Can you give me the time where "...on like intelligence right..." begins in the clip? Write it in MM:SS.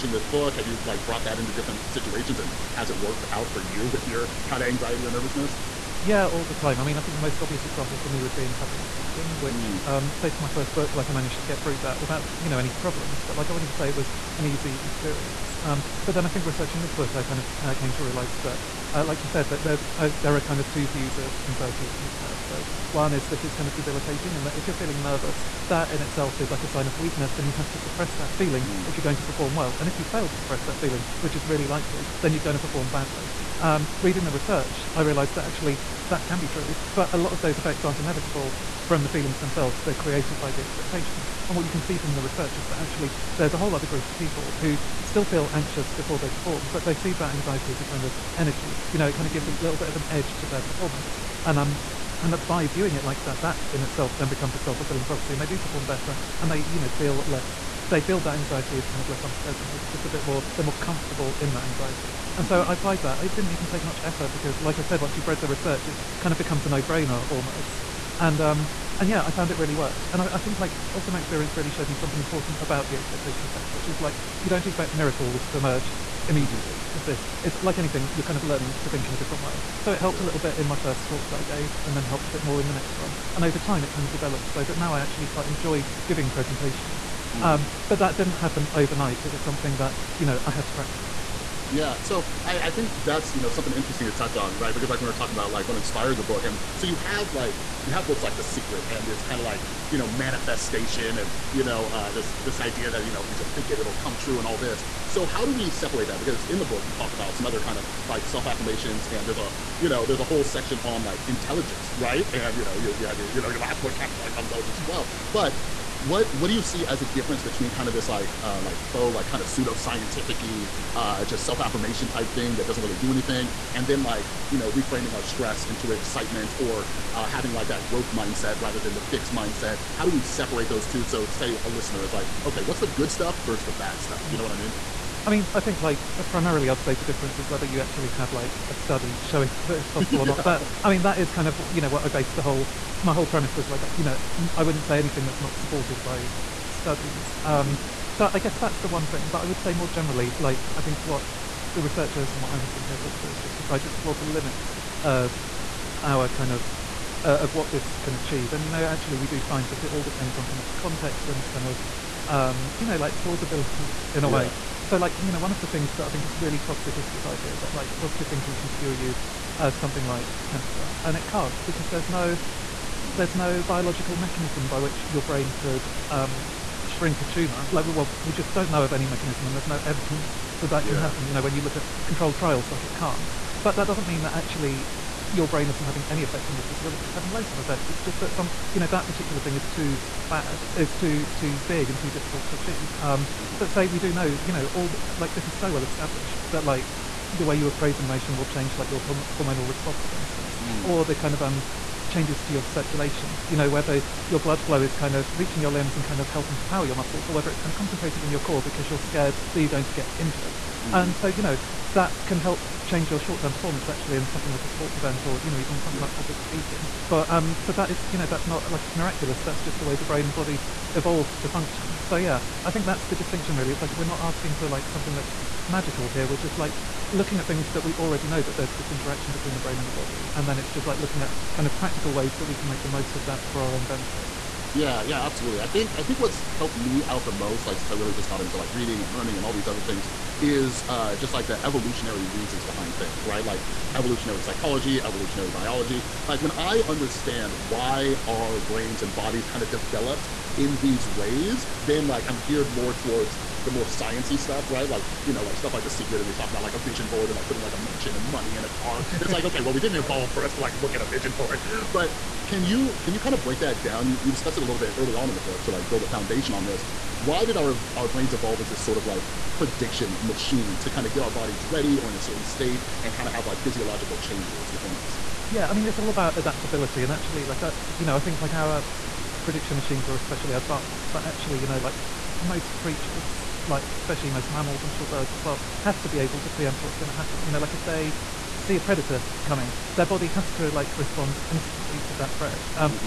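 01:50.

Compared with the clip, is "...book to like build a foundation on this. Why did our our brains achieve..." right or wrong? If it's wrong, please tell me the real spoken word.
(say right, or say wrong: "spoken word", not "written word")
wrong: "evolve", not "achieve".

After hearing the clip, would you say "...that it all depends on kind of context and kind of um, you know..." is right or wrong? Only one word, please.
right.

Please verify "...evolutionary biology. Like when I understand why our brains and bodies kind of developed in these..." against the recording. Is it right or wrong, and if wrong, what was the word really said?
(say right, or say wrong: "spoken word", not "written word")
right.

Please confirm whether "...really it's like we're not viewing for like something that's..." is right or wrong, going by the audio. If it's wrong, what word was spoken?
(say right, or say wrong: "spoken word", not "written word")
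wrong: "asking", not "viewing".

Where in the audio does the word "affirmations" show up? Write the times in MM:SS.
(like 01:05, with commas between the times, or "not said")
01:48, 02:01.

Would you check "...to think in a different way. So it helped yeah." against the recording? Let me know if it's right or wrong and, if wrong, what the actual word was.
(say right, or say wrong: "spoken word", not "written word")
right.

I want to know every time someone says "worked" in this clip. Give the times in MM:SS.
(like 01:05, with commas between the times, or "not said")
00:02, 01:09.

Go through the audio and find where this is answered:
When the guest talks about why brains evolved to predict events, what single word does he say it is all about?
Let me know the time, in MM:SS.
04:36.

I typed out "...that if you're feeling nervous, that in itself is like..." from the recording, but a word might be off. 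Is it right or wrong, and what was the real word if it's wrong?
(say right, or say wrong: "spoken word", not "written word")
right.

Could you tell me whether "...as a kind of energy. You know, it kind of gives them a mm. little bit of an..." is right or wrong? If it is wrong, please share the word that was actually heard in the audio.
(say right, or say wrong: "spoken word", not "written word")
right.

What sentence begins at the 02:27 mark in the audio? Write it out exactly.
Um, mm So I guess that's the one thing.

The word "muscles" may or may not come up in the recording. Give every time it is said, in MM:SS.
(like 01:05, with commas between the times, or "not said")
03:26.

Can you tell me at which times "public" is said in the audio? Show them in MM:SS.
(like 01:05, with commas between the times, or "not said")
00:08, 03:36.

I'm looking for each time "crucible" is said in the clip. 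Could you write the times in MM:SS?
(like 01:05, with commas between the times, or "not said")
not said.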